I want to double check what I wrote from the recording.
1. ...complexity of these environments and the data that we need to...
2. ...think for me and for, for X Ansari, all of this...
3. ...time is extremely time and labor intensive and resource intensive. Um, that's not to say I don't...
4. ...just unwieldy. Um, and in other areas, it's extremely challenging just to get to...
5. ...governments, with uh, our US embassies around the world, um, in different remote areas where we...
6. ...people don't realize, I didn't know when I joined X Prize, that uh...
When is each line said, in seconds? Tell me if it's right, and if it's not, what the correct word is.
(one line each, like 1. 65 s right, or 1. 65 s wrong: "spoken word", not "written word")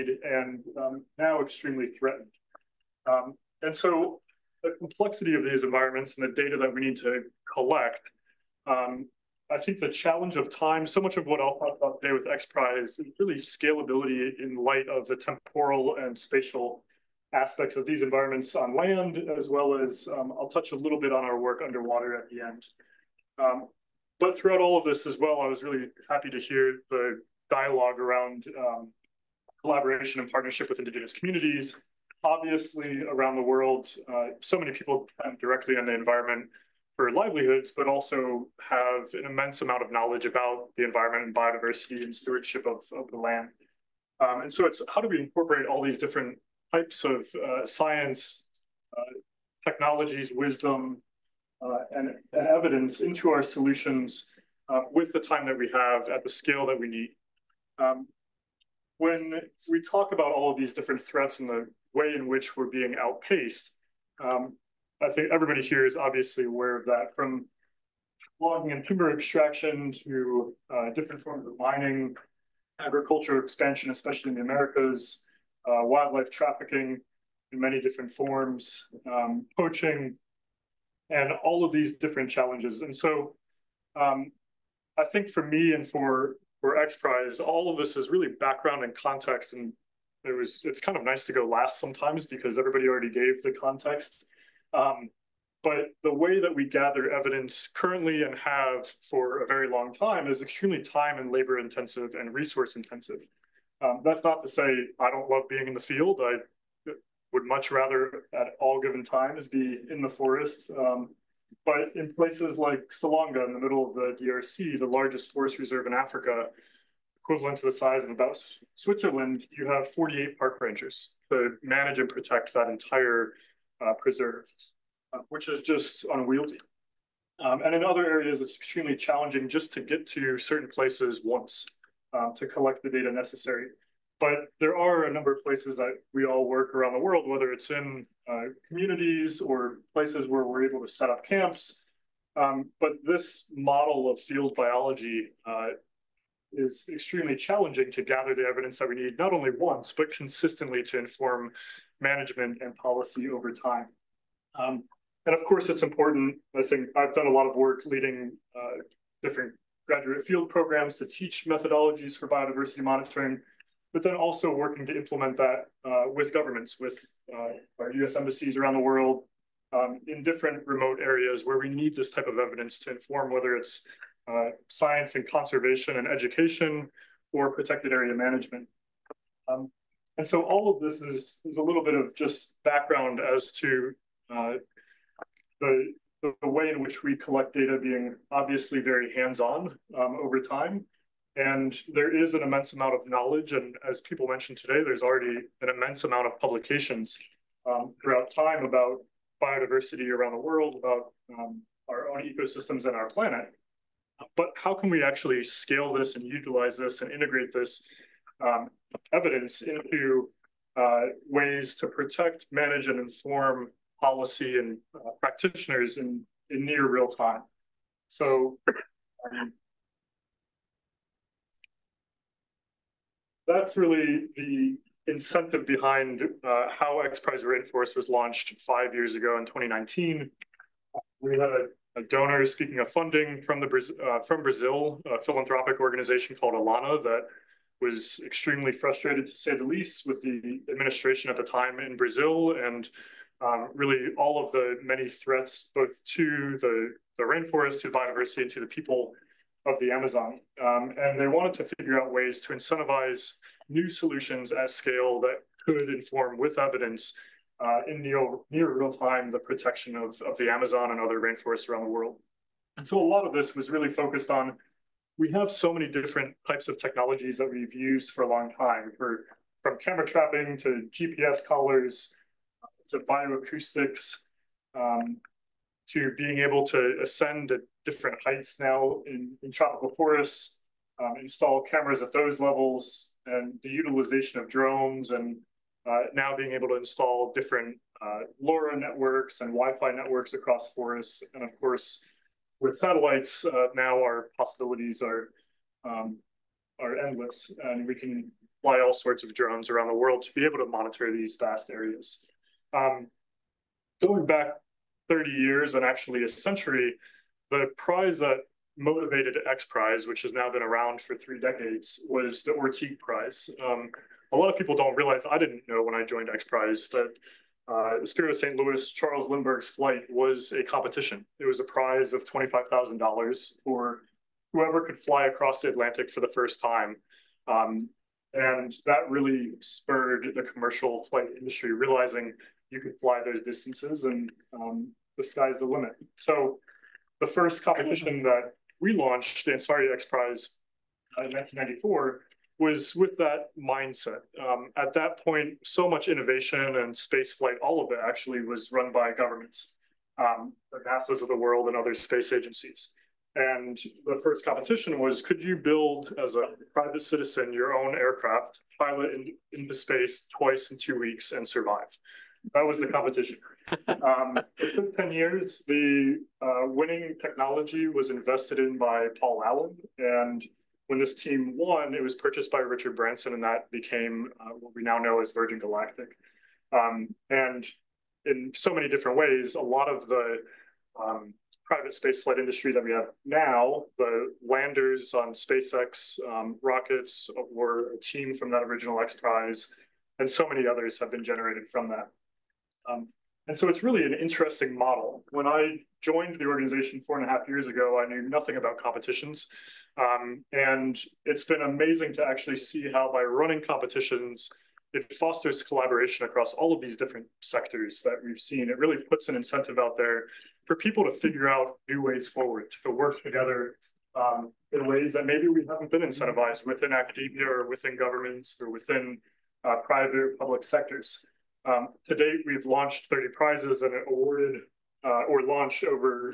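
1. 4 s right
2. 85 s wrong: "Prize", not "Ansari"
3. 99 s right
4. 125 s right
5. 166 s right
6. 314 s right.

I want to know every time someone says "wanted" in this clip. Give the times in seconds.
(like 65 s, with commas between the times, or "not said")
251 s.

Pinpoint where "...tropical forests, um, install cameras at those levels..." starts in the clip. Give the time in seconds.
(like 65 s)
279 s.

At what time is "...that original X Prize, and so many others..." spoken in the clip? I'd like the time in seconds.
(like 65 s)
388 s.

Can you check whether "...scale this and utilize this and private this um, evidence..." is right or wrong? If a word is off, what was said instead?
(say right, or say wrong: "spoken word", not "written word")
wrong: "integrate", not "private".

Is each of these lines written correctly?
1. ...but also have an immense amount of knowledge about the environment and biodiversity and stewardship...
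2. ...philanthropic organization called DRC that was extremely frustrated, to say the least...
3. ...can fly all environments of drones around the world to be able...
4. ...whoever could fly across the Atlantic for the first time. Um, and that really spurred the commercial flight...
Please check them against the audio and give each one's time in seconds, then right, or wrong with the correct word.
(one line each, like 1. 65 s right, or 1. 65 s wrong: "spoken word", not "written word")
1. 37 s right
2. 235 s wrong: "Alana", not "DRC"
3. 297 s wrong: "sorts", not "environments"
4. 324 s right.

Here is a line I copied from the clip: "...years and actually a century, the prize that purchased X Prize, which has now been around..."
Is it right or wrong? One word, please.
wrong.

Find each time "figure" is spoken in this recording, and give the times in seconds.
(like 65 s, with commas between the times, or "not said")
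251 s, 411 s.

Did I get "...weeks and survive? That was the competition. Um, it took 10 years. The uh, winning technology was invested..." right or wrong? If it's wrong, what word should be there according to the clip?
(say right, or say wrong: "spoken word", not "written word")
right.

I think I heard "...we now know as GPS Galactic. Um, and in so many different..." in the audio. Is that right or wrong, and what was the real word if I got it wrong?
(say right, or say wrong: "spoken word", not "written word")
wrong: "Virgin", not "GPS".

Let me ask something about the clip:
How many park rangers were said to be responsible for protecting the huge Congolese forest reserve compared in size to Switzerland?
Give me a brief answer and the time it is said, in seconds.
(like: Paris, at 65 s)
48, at 119 s.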